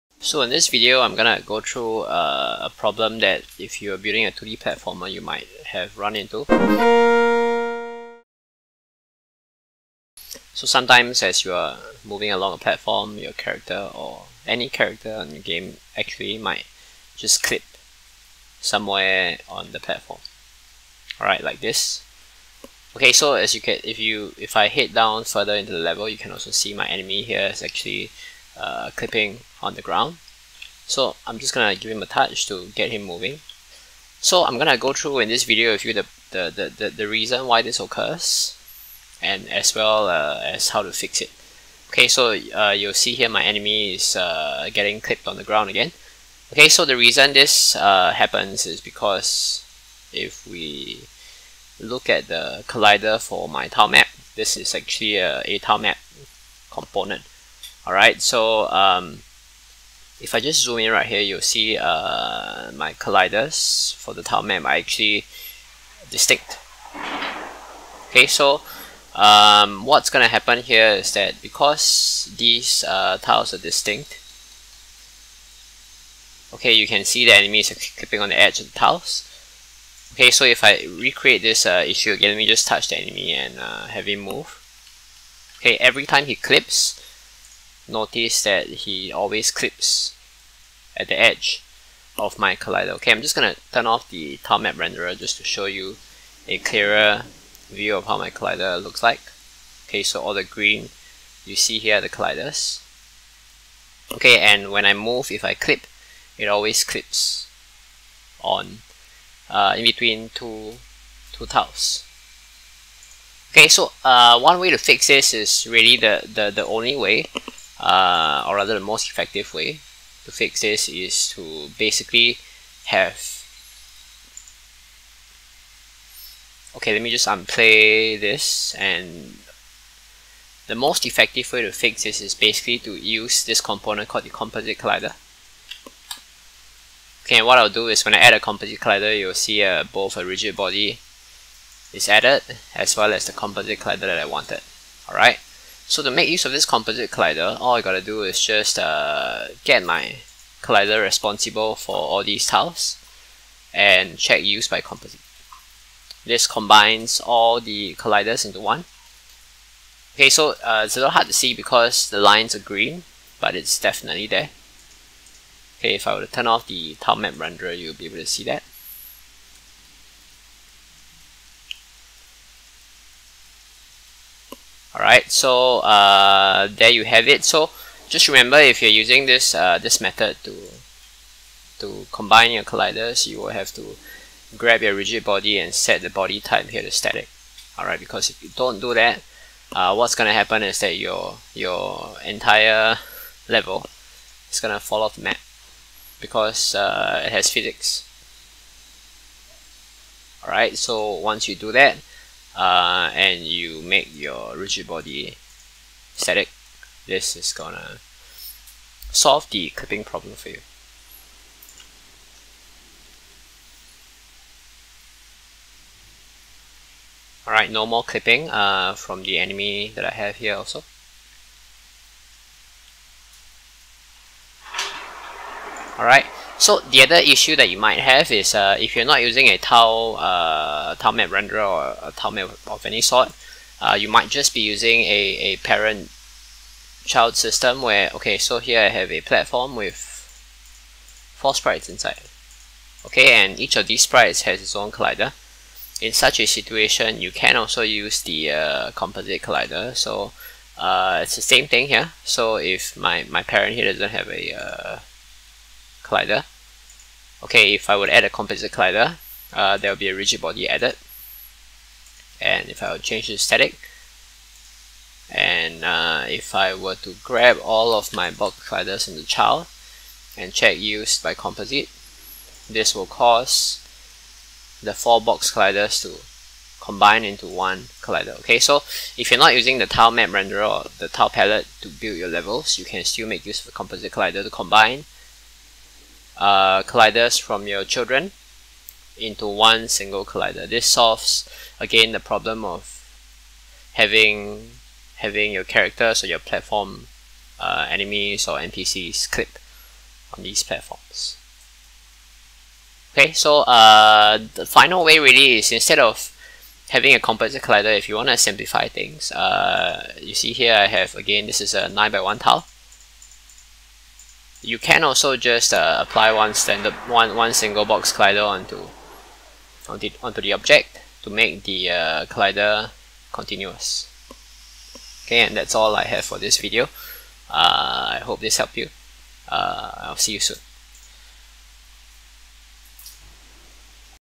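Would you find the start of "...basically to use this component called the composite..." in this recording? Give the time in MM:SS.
02:12.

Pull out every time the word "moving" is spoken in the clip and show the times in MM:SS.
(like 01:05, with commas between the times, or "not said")
00:12, 00:33.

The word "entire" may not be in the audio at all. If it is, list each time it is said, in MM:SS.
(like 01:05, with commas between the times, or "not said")
03:12.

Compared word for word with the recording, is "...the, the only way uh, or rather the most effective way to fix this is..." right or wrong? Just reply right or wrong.
right.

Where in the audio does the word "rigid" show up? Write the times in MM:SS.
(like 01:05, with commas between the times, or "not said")
02:20, 03:04, 03:24, 04:20.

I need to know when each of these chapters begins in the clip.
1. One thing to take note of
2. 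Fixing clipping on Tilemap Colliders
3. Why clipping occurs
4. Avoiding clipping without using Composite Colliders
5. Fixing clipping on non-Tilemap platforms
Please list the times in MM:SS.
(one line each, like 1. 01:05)
1. 02:58
2. 02:10
3. 00:41
4. 05:02
5. 03:45.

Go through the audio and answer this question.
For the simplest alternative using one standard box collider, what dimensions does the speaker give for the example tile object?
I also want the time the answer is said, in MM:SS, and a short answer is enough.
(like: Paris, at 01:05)
9 by 1, at 05:11.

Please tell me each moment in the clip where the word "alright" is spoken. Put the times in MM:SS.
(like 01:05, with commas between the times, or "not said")
00:21, 00:57, 02:25, 02:55, 03:07, 03:20, 03:37, 03:45.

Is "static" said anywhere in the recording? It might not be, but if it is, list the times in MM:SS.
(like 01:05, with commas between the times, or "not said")
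03:06, 03:26, 04:23.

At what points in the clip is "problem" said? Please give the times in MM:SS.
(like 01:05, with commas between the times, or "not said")
00:02, 03:30, 04:52.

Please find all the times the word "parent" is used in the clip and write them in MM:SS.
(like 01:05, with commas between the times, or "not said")
03:55, 04:13.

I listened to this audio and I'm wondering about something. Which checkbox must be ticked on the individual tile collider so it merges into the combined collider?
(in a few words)
Use by composite.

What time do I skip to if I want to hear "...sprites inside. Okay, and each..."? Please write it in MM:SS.
04:01.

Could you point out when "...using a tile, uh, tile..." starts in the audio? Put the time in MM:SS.
03:49.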